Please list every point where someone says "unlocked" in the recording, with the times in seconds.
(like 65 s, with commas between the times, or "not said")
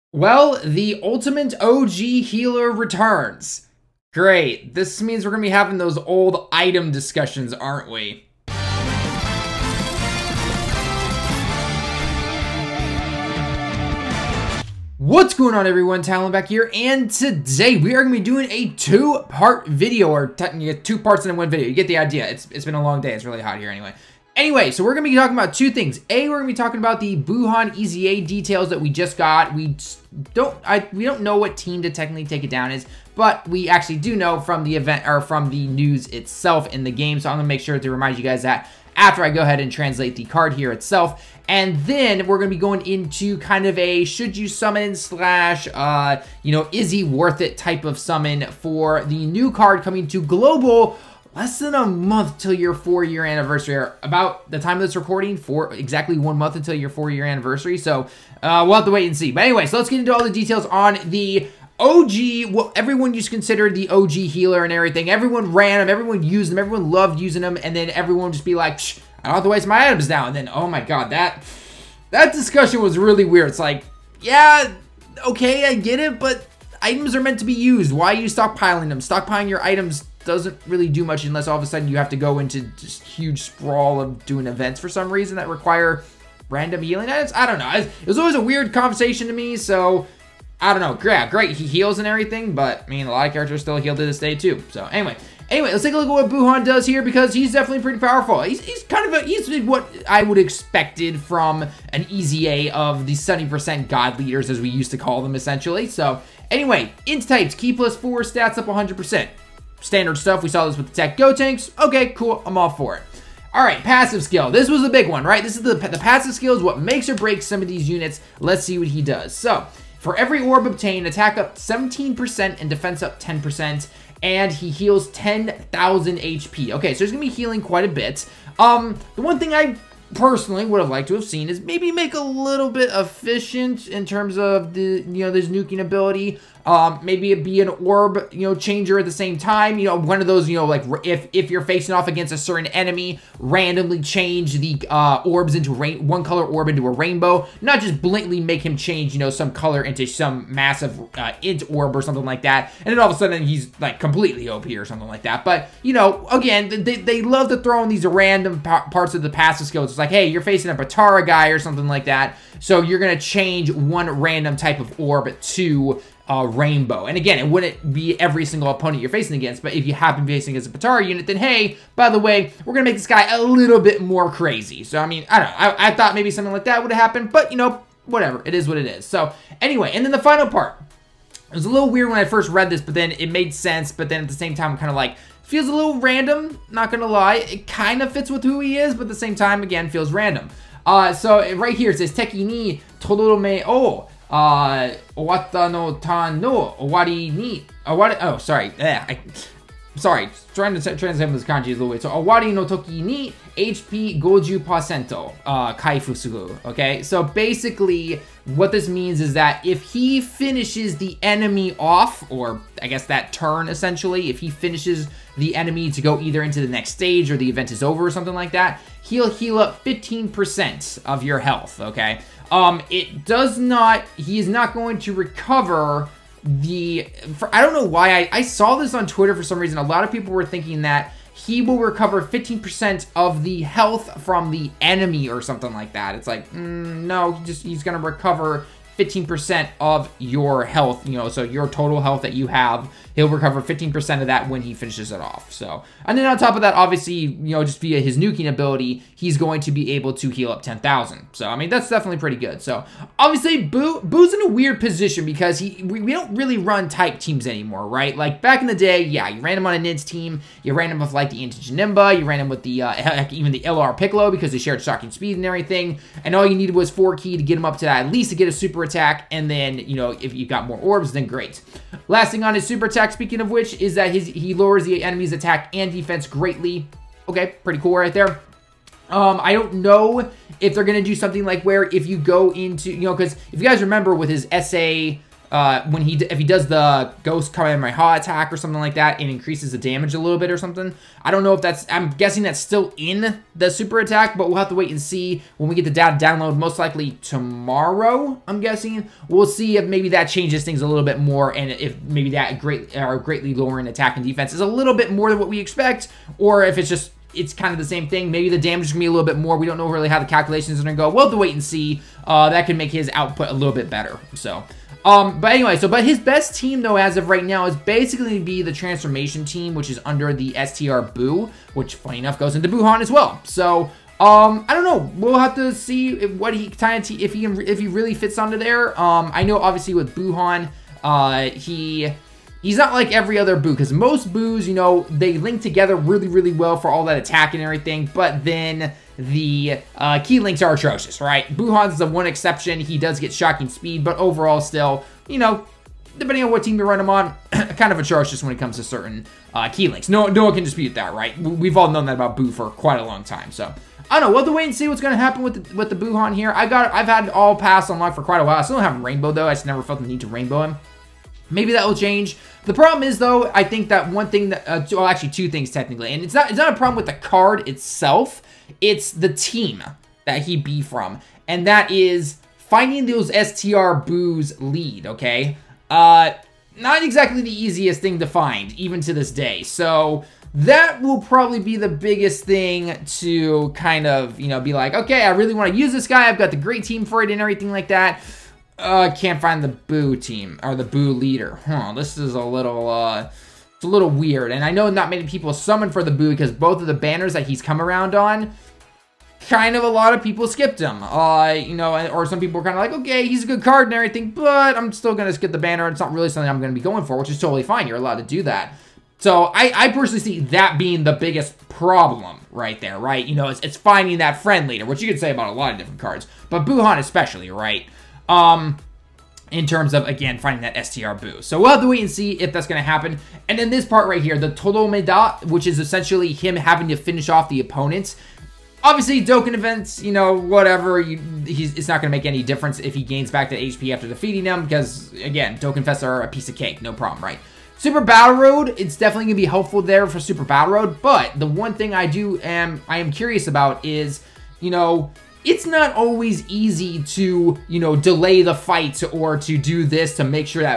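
357 s.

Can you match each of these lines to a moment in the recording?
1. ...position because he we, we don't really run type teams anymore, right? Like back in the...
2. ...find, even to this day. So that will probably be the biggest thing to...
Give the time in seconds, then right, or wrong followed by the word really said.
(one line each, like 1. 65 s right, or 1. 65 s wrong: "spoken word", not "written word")
1. 254 s right
2. 378 s right.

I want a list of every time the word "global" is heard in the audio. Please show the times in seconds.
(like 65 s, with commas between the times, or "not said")
50 s.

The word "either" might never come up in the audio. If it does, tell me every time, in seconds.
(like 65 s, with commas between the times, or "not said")
216 s.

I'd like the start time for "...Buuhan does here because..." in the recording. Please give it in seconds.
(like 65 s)
96 s.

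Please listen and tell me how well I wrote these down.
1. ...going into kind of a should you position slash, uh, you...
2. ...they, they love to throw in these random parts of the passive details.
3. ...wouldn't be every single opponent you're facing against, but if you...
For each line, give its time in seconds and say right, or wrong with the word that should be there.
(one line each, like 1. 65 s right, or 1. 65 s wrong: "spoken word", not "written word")
1. 42 s wrong: "summon", not "position"
2. 156 s wrong: "skills", not "details"
3. 167 s right.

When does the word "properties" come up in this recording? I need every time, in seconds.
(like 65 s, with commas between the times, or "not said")
not said.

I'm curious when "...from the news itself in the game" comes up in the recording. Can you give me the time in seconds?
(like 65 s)
35 s.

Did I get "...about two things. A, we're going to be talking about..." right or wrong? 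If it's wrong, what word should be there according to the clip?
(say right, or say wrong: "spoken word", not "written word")
right.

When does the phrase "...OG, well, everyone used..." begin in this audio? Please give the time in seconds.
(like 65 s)
61 s.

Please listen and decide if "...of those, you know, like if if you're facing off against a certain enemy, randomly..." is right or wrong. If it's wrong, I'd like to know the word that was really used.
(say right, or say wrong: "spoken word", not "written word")
right.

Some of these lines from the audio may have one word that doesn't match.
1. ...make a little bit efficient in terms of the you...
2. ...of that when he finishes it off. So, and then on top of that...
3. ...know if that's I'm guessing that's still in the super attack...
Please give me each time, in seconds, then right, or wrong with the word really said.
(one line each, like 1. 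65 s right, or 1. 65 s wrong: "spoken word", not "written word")
1. 131 s right
2. 244 s right
3. 291 s right.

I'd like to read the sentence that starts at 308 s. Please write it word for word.
Maybe the damage is going to be a little bit more.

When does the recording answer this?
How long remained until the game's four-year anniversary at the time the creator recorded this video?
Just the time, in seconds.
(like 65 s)
55 s.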